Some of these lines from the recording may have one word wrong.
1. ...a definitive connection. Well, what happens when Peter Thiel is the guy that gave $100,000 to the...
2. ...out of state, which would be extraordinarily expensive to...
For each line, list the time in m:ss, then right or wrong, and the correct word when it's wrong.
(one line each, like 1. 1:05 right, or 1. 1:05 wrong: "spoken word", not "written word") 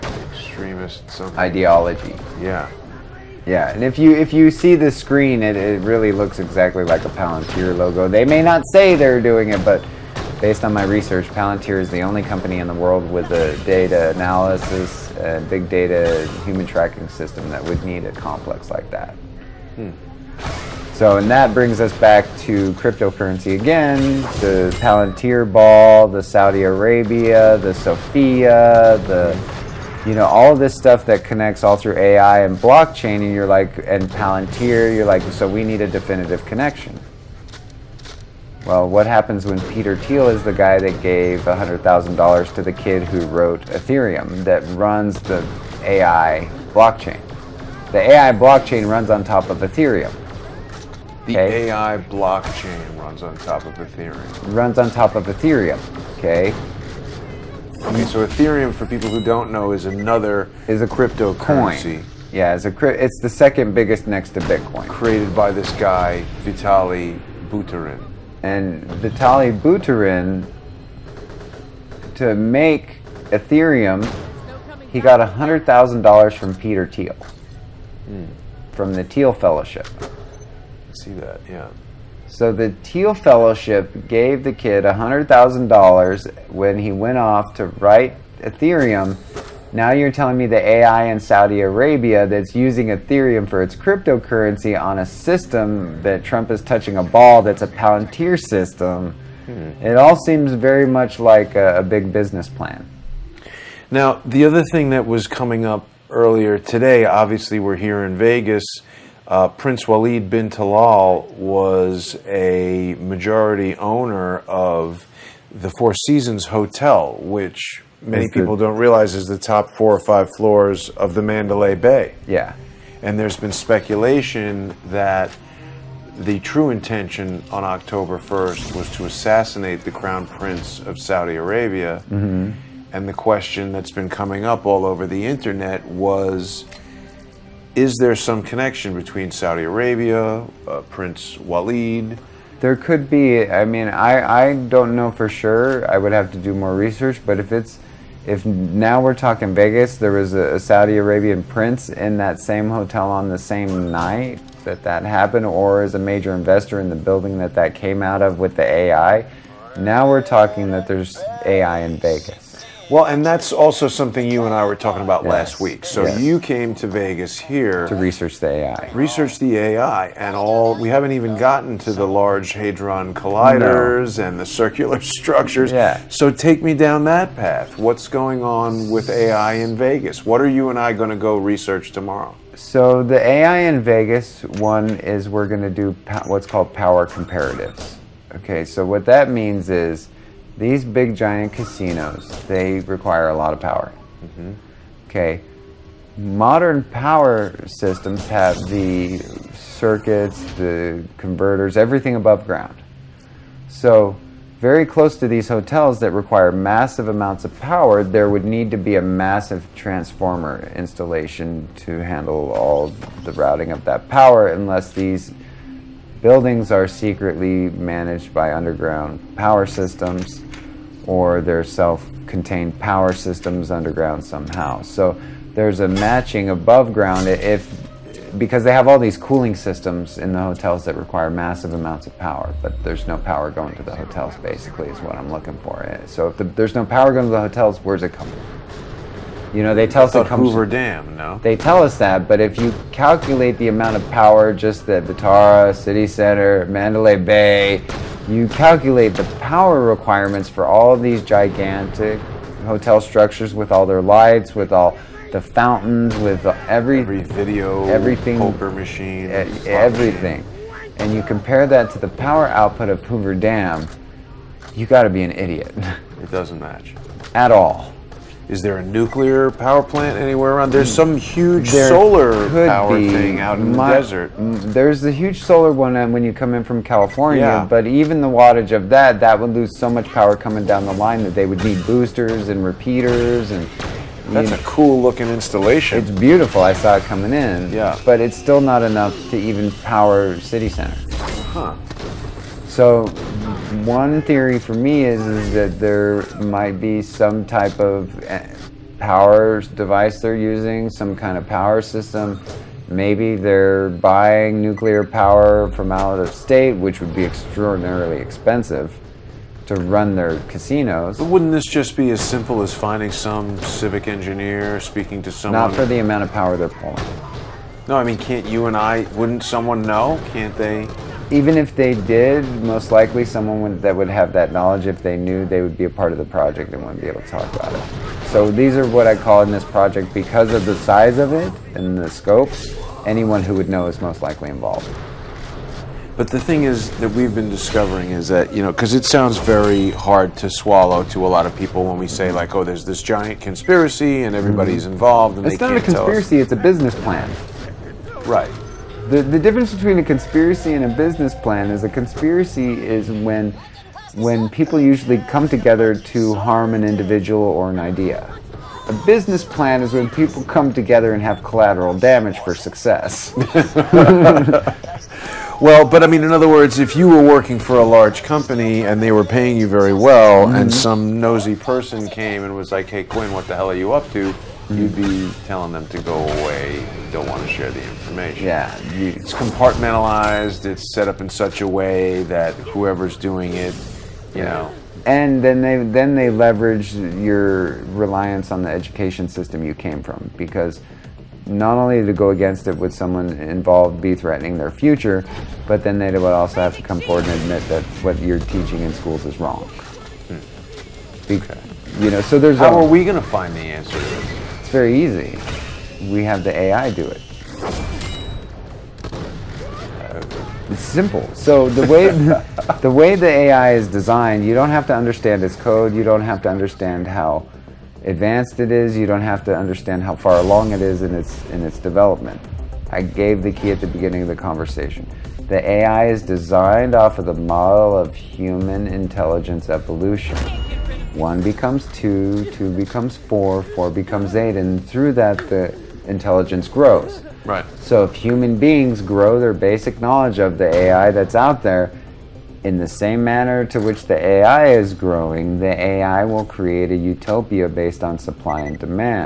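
1. 0:35 right
2. 5:05 right.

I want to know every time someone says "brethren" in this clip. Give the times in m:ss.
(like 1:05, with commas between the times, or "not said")
not said.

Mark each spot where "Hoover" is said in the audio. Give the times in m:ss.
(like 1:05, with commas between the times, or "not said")
4:00, 4:23.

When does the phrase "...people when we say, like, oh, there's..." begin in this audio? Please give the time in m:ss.
5:41.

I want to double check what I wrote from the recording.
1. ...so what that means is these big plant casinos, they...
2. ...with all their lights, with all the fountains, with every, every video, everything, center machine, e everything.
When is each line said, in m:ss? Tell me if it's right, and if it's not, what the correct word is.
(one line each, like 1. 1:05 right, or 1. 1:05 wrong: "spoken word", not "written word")
1. 3:08 wrong: "giant", not "plant"
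2. 4:13 wrong: "poker", not "center".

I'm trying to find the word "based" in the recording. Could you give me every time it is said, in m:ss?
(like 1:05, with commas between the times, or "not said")
0:10, 7:27.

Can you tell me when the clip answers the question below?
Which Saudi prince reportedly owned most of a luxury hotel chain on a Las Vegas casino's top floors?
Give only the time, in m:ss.
1:49.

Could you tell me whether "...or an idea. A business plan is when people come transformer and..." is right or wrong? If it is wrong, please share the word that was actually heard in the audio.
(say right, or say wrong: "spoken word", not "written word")
wrong: "together", not "transformer".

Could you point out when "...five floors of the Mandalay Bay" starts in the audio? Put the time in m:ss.
1:59.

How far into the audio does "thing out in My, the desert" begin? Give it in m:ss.
4:33.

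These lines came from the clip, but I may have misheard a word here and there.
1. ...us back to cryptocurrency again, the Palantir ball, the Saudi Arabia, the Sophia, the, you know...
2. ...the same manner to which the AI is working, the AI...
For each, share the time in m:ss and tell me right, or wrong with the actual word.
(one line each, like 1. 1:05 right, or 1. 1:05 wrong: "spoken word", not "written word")
1. 0:21 right
2. 7:22 wrong: "growing", not "working".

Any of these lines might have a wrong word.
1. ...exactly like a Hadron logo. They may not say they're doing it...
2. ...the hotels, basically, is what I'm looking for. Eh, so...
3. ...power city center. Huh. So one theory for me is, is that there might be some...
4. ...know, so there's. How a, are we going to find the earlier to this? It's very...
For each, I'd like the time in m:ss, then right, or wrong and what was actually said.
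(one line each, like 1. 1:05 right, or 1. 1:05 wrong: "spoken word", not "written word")
1. 0:06 wrong: "Palantir", not "Hadron"
2. 3:53 right
3. 4:49 right
4. 6:42 wrong: "answer", not "earlier".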